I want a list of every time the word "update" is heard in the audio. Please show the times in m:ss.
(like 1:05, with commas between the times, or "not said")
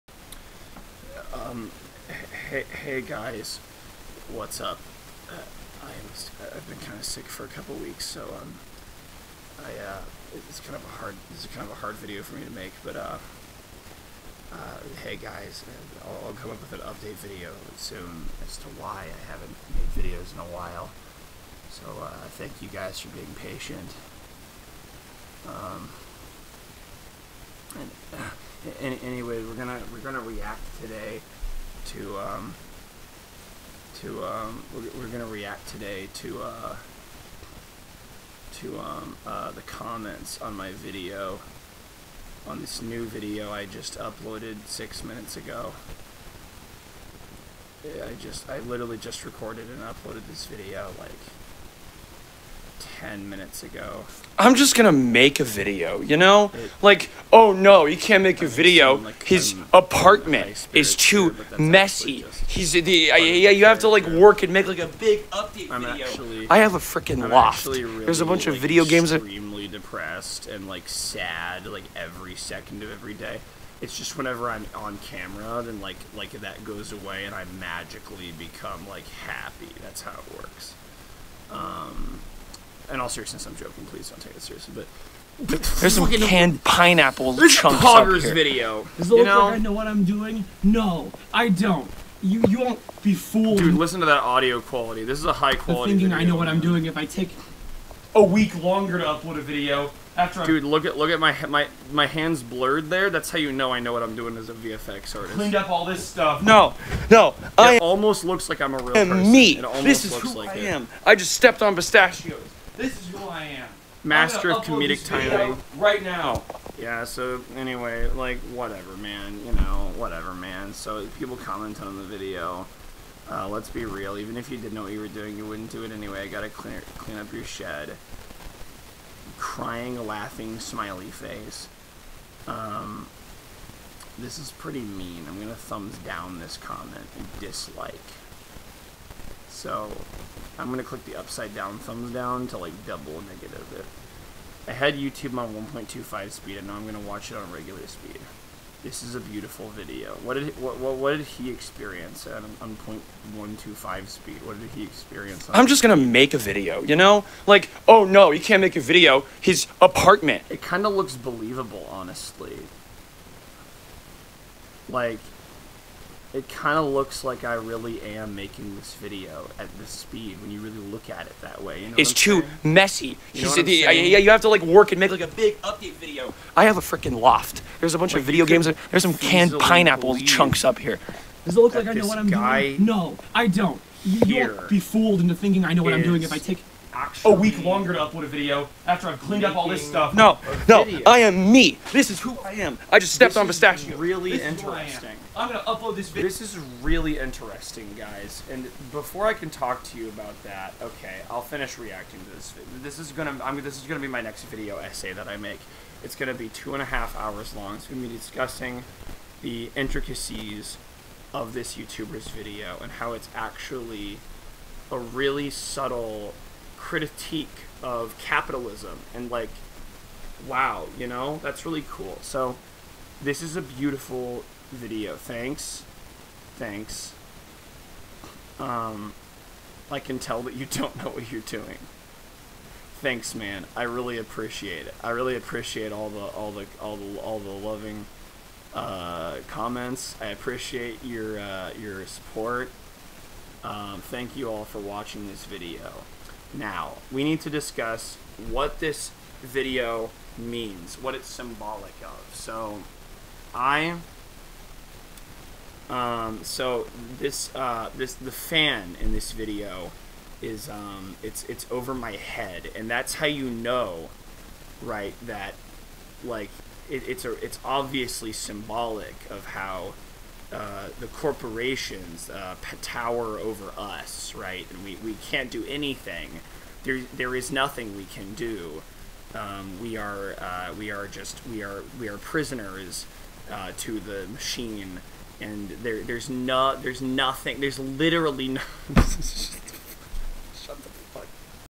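0:16, 1:05, 2:55.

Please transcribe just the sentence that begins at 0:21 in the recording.
So uh, thank you guys for being patient.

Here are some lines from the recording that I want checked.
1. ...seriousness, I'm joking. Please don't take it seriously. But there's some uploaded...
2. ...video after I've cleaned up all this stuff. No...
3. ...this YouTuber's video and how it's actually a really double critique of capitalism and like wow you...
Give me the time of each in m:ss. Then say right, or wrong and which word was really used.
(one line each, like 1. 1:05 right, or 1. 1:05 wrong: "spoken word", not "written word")
1. 1:23 wrong: "canned", not "uploaded"
2. 3:08 right
3. 3:31 wrong: "subtle", not "double".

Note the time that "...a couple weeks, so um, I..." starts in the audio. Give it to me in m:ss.
0:07.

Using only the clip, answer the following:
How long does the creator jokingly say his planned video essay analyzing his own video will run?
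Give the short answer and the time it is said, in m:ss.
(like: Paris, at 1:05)
2 and a half hours, at 3:26.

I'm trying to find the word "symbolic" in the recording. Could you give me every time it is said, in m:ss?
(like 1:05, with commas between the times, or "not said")
4:11, 4:28.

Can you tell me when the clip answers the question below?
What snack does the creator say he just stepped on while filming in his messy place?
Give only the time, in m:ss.
1:51.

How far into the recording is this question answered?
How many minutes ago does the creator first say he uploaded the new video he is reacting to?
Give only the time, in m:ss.
0:44.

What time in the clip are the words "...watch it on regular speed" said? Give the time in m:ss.
2:27.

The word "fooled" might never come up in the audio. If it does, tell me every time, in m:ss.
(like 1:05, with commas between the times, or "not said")
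1:33, 3:04.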